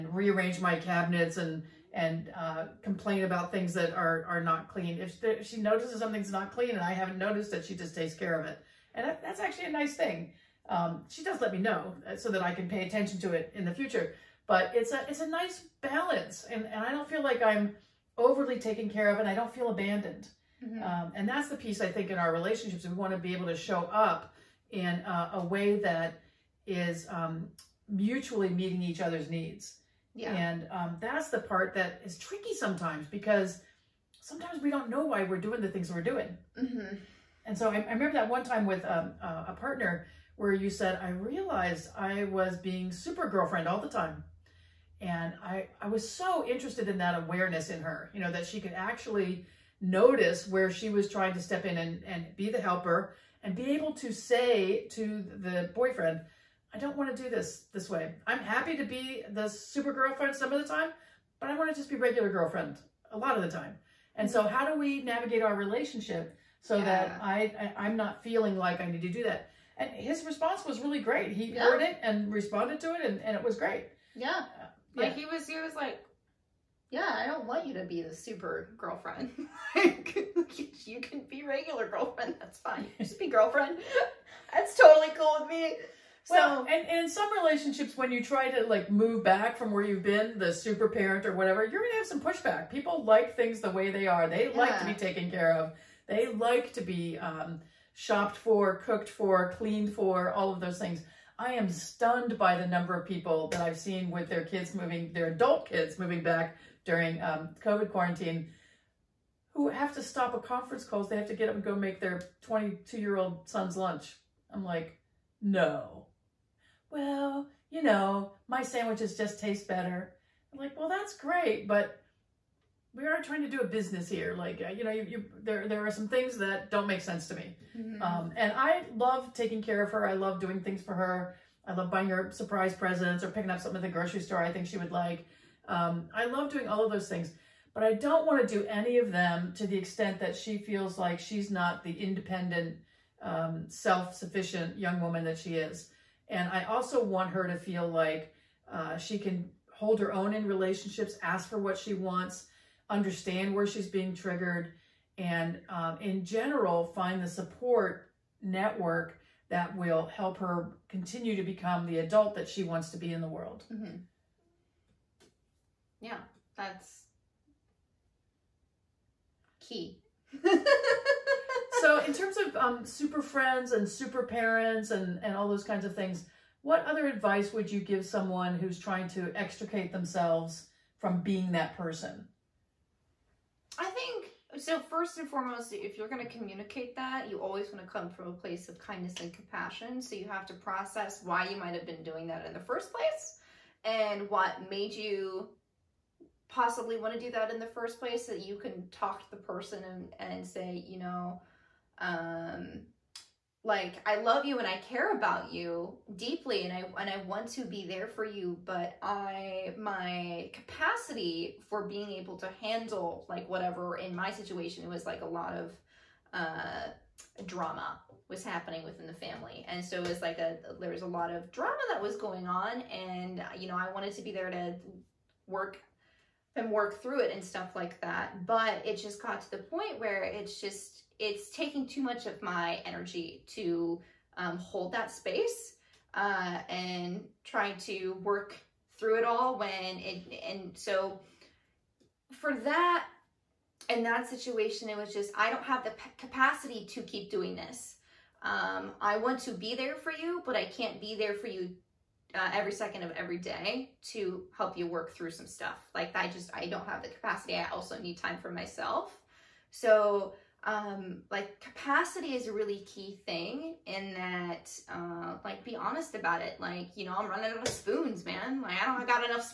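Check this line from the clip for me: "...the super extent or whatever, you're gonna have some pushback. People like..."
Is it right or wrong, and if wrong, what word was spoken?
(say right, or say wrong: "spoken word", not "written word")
wrong: "parent", not "extent".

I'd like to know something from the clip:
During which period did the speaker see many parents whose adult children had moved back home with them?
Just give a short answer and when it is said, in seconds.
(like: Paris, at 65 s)
COVID quarantine, at 107 s.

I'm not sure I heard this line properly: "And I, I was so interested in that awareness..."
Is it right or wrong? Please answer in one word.
right.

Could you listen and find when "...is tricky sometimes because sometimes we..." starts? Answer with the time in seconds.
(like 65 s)
32 s.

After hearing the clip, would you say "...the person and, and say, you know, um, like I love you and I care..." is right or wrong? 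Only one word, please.
right.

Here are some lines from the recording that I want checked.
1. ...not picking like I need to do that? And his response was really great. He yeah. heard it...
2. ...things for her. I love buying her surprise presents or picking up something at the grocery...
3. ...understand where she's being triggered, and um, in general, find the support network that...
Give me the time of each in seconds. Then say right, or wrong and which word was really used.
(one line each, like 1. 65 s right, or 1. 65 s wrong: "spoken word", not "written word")
1. 67 s wrong: "feeling", not "picking"
2. 130 s right
3. 152 s right.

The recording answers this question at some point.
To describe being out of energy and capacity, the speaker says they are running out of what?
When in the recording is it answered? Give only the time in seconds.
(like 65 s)
267 s.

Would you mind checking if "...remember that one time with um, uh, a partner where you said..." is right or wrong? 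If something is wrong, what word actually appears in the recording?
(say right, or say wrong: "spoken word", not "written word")
right.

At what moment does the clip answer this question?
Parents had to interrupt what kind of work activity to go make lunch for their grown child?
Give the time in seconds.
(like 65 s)
110 s.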